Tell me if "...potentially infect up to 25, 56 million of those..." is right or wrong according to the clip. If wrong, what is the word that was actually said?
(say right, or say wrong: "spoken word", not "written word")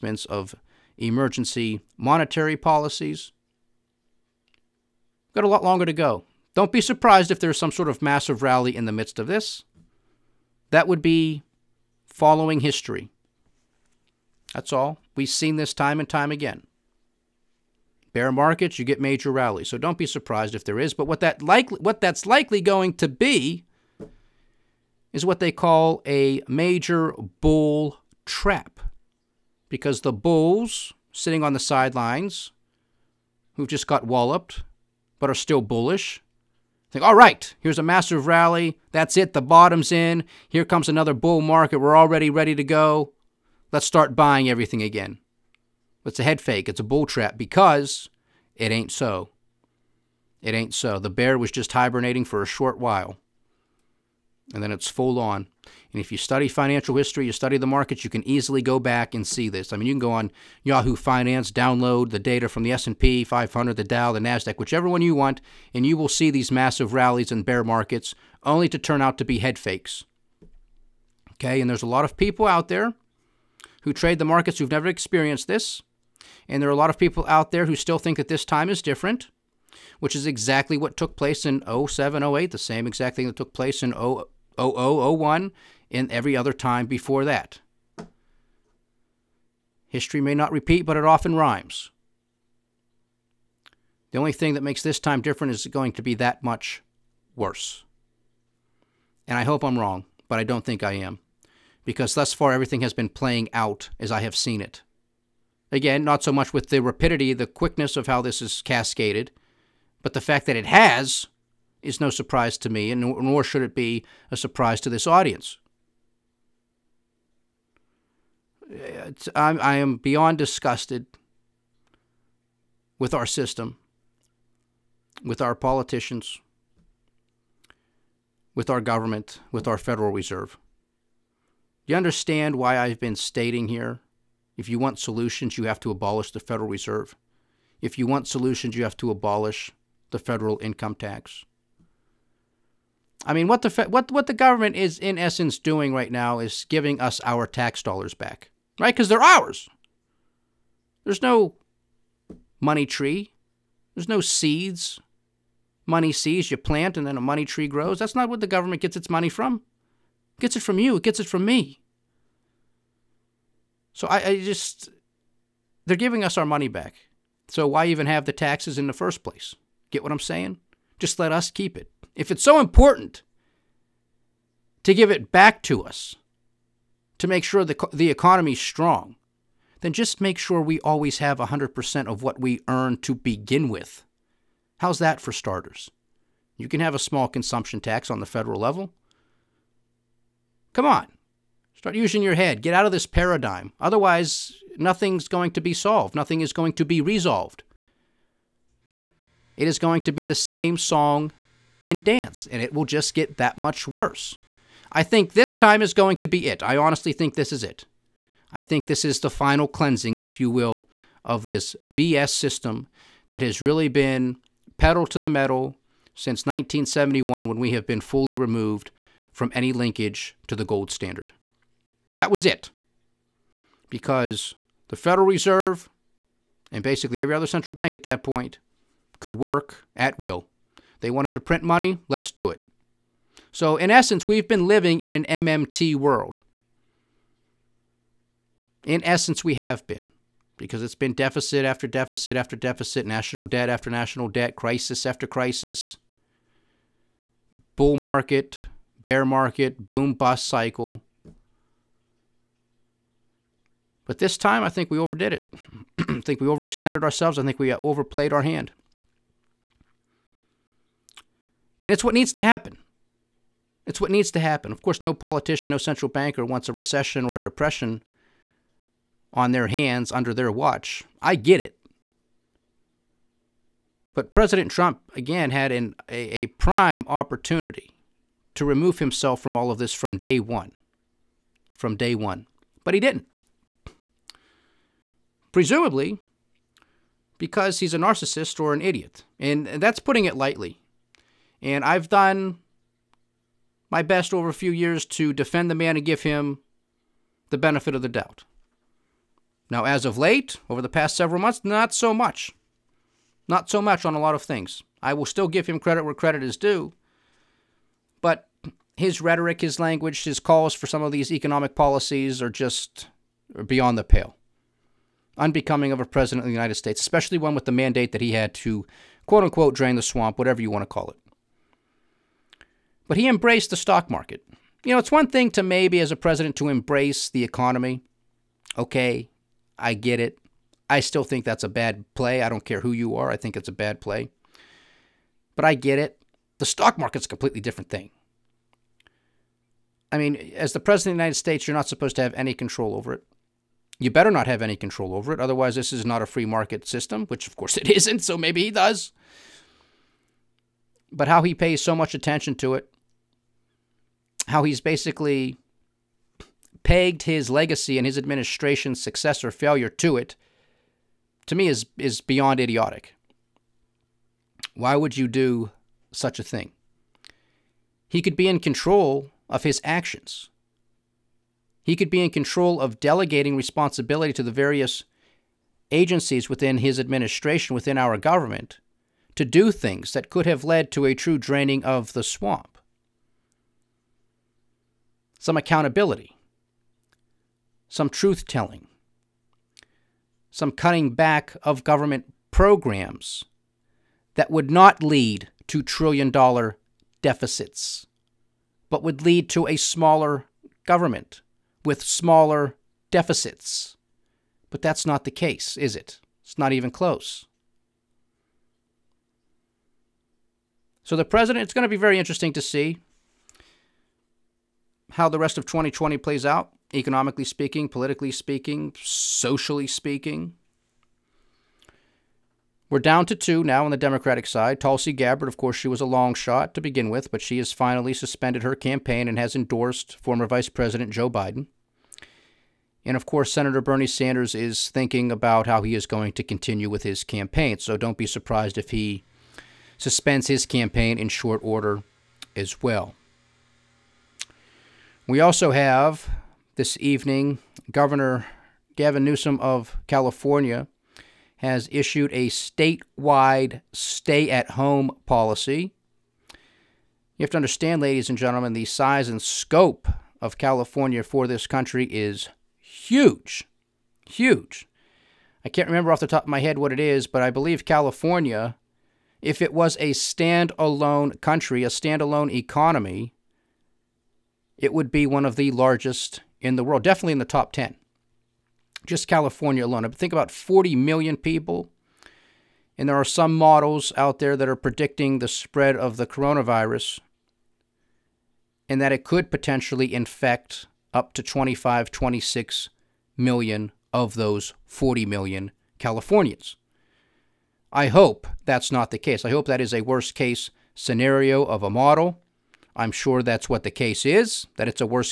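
wrong: "26", not "56".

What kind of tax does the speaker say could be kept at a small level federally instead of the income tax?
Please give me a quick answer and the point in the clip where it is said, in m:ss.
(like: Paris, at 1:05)
consumption tax, at 3:07.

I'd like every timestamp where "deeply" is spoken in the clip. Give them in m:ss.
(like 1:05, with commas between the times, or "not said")
not said.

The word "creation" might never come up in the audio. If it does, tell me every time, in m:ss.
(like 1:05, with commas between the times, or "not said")
not said.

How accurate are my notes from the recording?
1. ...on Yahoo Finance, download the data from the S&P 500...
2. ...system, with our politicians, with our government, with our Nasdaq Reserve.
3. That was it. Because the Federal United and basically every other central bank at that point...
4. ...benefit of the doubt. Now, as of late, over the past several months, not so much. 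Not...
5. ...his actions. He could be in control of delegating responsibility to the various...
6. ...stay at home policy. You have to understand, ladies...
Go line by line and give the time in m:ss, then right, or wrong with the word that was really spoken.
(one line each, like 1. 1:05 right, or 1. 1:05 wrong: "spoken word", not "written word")
1. 1:00 right
2. 2:03 wrong: "Federal", not "Nasdaq"
3. 3:42 wrong: "Reserve", not "United"
4. 4:57 right
5. 6:09 right
6. 7:33 right.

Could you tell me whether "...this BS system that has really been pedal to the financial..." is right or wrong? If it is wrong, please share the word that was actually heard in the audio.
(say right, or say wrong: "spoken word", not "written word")
wrong: "metal", not "financial".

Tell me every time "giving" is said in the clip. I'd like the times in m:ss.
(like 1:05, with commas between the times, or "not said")
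2:26, 2:45.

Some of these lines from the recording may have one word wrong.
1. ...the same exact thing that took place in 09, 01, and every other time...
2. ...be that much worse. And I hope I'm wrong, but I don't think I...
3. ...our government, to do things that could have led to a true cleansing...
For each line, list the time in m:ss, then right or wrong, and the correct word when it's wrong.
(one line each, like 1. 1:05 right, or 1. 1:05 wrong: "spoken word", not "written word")
1. 1:22 wrong: "00", not "09"
2. 1:36 right
3. 6:17 wrong: "draining", not "cleansing".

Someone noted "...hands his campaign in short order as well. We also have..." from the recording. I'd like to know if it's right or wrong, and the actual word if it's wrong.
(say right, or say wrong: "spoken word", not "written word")
wrong: "suspends", not "hands".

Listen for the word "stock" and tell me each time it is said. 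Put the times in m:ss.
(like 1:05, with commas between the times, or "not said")
5:23, 5:36.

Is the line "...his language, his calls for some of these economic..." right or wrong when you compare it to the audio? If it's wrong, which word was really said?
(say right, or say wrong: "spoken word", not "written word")
right.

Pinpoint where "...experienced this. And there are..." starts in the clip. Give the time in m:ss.
1:14.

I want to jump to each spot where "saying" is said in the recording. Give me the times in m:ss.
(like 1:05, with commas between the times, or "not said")
2:50.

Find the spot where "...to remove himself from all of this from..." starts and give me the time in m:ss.
4:38.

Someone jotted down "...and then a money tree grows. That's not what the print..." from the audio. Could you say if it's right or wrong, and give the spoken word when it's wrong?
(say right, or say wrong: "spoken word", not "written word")
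wrong: "government", not "print".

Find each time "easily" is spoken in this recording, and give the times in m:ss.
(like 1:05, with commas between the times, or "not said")
0:58.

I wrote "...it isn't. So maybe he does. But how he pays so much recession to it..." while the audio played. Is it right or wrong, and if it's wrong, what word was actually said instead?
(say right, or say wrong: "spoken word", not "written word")
wrong: "attention", not "recession".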